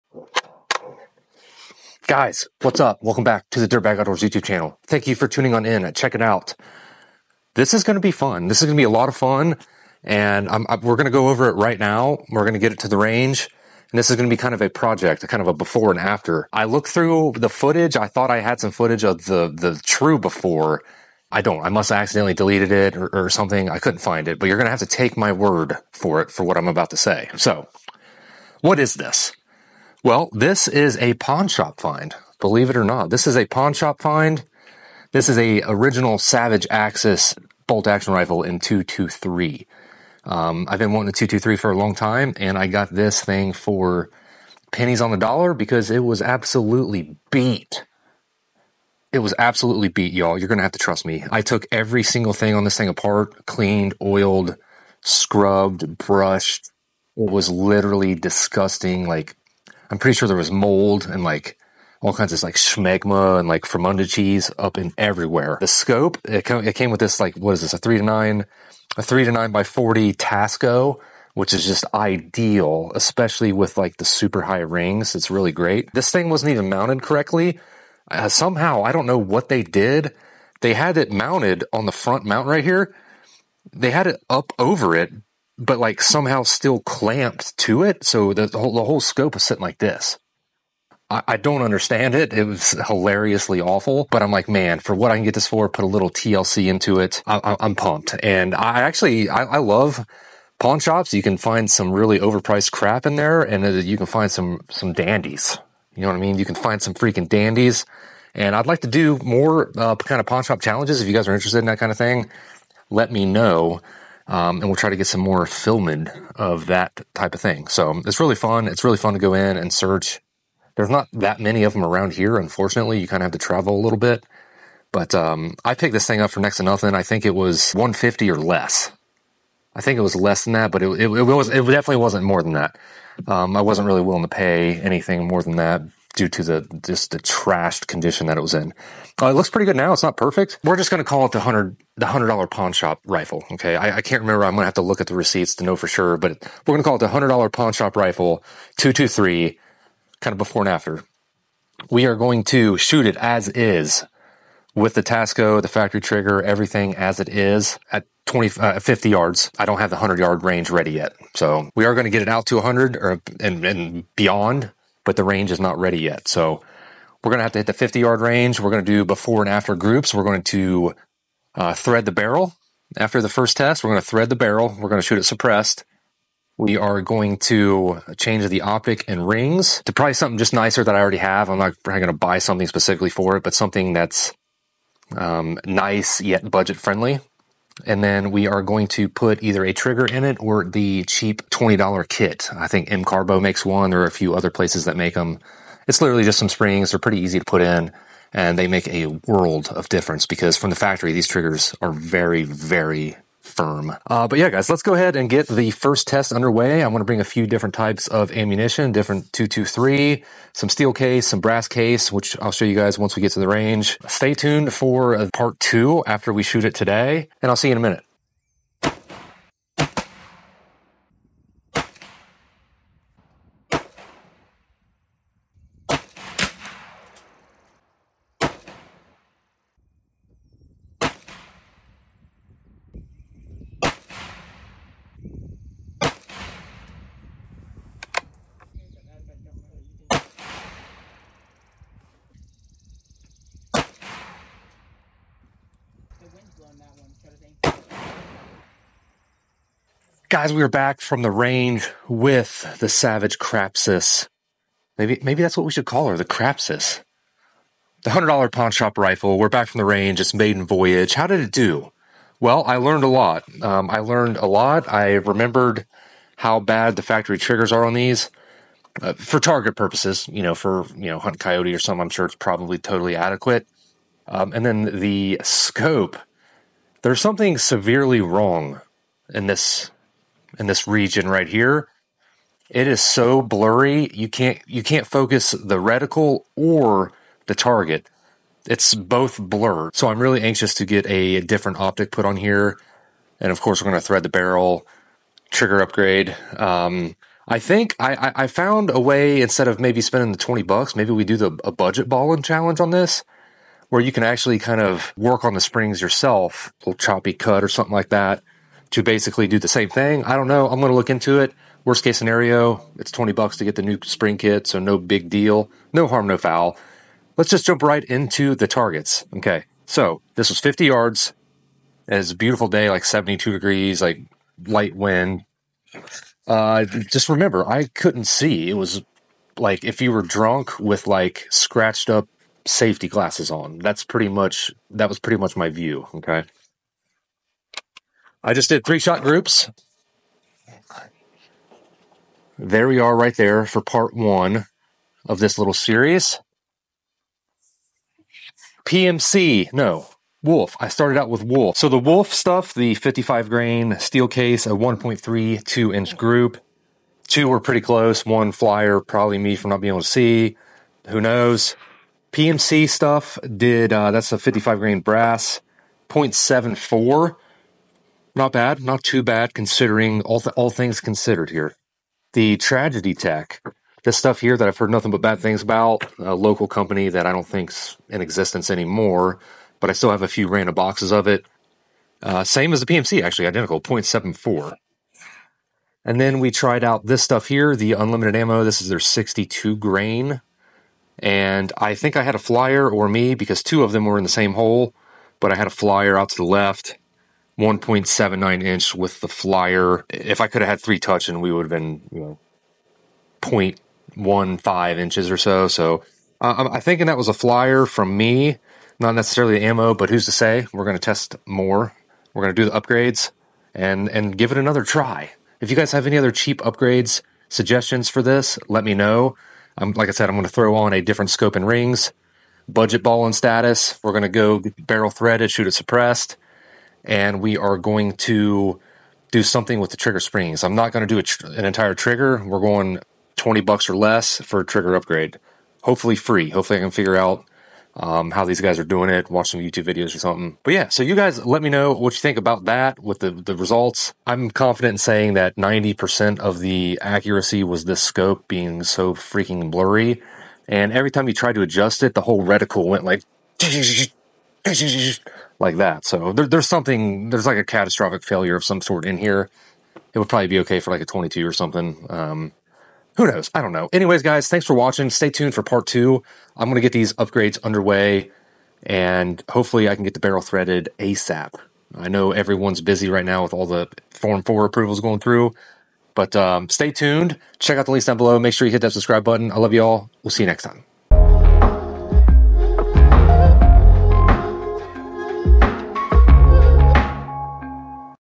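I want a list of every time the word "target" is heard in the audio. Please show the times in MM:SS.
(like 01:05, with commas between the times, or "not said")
04:29, 04:47, 05:18.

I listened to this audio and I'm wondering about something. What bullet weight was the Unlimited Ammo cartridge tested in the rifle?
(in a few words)
62 grain.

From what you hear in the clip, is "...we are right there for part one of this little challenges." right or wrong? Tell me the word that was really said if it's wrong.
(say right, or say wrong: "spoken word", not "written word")
wrong: "series", not "challenges".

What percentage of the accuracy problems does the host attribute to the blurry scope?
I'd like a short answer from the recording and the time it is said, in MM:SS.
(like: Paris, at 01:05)
90%, at 07:25.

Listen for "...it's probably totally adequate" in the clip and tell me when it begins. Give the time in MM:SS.
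04:32.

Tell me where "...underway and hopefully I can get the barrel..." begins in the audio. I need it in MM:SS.
07:47.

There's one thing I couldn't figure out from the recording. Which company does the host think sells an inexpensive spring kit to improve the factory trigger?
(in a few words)
MCARBO.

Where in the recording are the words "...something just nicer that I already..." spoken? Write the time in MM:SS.
03:00.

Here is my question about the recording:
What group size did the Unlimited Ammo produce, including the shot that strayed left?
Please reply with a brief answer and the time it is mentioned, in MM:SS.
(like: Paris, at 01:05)
1.79 inches, at 06:37.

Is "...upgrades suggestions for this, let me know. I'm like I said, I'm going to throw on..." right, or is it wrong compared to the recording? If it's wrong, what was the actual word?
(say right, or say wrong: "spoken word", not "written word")
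right.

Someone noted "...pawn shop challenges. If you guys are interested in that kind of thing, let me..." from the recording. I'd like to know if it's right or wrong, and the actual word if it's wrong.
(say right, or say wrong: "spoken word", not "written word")
right.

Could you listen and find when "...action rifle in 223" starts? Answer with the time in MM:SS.
00:37.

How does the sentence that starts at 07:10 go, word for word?
I'm not going to do tr- an entire trigger.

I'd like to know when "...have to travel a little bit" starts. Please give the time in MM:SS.
02:03.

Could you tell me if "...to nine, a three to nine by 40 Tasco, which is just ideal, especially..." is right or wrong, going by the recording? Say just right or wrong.
right.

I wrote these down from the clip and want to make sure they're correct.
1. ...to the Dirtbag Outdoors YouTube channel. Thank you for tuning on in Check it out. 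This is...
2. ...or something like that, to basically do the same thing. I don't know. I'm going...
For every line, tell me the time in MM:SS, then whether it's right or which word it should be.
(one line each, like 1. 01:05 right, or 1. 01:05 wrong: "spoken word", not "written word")
1. 00:03 right
2. 05:07 right.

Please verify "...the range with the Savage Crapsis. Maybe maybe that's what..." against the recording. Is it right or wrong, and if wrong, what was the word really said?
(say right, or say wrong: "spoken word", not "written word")
right.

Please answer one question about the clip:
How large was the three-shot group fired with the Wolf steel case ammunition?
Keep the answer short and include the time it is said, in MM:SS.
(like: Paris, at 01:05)
1.32 inches, at 05:54.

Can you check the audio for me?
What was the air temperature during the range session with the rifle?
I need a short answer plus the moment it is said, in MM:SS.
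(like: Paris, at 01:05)
72 degrees, at 05:23.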